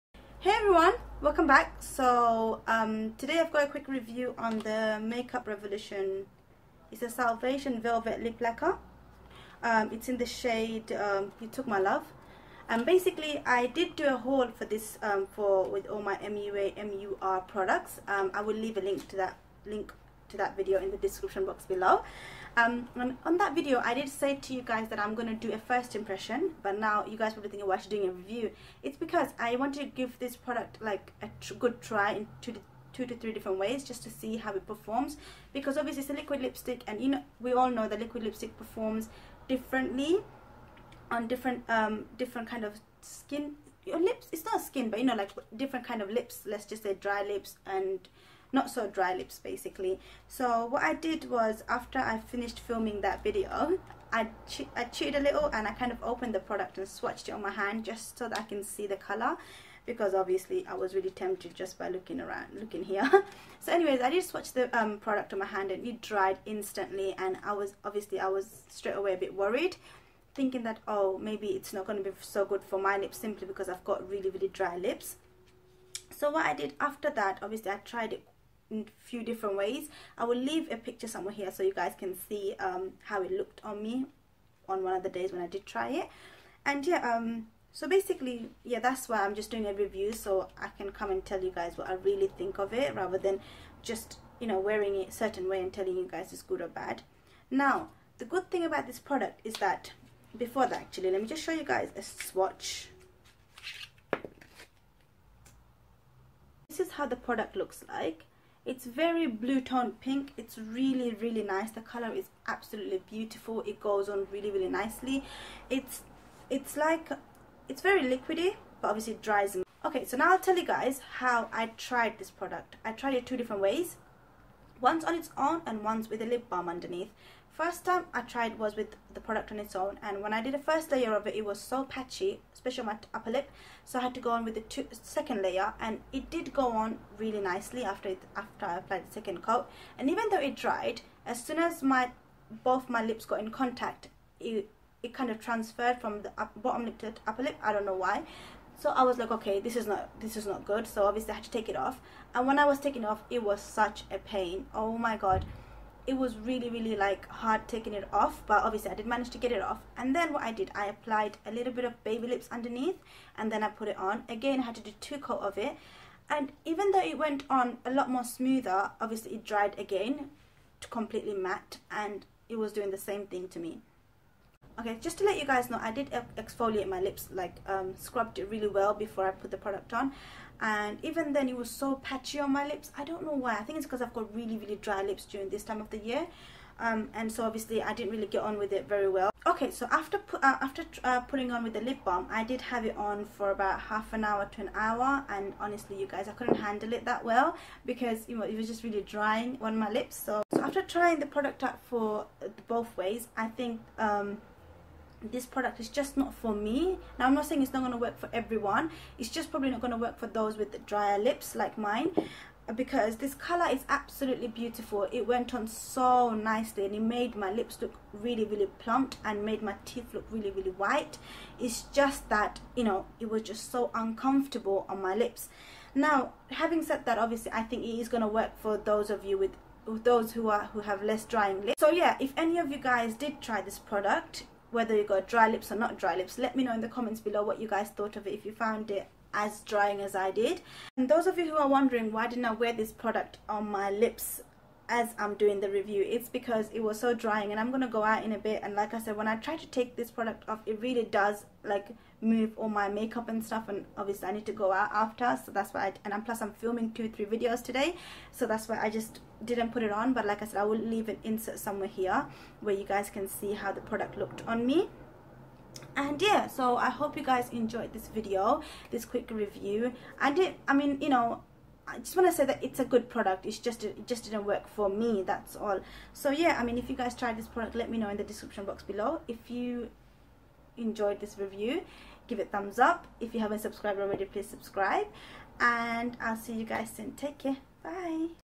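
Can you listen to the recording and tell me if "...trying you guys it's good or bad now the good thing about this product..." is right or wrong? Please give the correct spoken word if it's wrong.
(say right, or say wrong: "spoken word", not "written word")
wrong: "telling", not "trying".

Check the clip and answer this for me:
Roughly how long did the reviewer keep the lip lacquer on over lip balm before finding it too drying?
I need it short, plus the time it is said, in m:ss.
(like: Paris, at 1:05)
Half an hour to an hour, at 3:13.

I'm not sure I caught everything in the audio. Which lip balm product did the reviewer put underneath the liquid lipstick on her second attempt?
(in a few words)
Baby Lips.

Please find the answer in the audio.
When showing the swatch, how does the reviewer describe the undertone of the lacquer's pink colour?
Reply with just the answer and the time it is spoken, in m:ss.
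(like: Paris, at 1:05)
Blue tone, at 1:49.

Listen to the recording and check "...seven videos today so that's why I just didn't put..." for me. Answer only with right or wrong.
wrong.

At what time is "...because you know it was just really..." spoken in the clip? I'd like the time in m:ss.
3:17.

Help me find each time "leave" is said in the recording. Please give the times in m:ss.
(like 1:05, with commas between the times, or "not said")
0:18, 1:20, 4:20.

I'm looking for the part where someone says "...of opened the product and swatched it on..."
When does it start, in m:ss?
0:55.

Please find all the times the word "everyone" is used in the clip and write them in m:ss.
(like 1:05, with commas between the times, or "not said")
0:00, 3:28.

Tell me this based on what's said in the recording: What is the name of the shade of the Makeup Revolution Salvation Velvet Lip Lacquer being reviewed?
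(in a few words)
You Took My Love.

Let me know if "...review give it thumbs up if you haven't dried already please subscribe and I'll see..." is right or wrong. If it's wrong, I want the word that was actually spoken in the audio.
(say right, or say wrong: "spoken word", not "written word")
wrong: "subscribed", not "dried".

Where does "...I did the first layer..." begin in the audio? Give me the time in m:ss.
2:10.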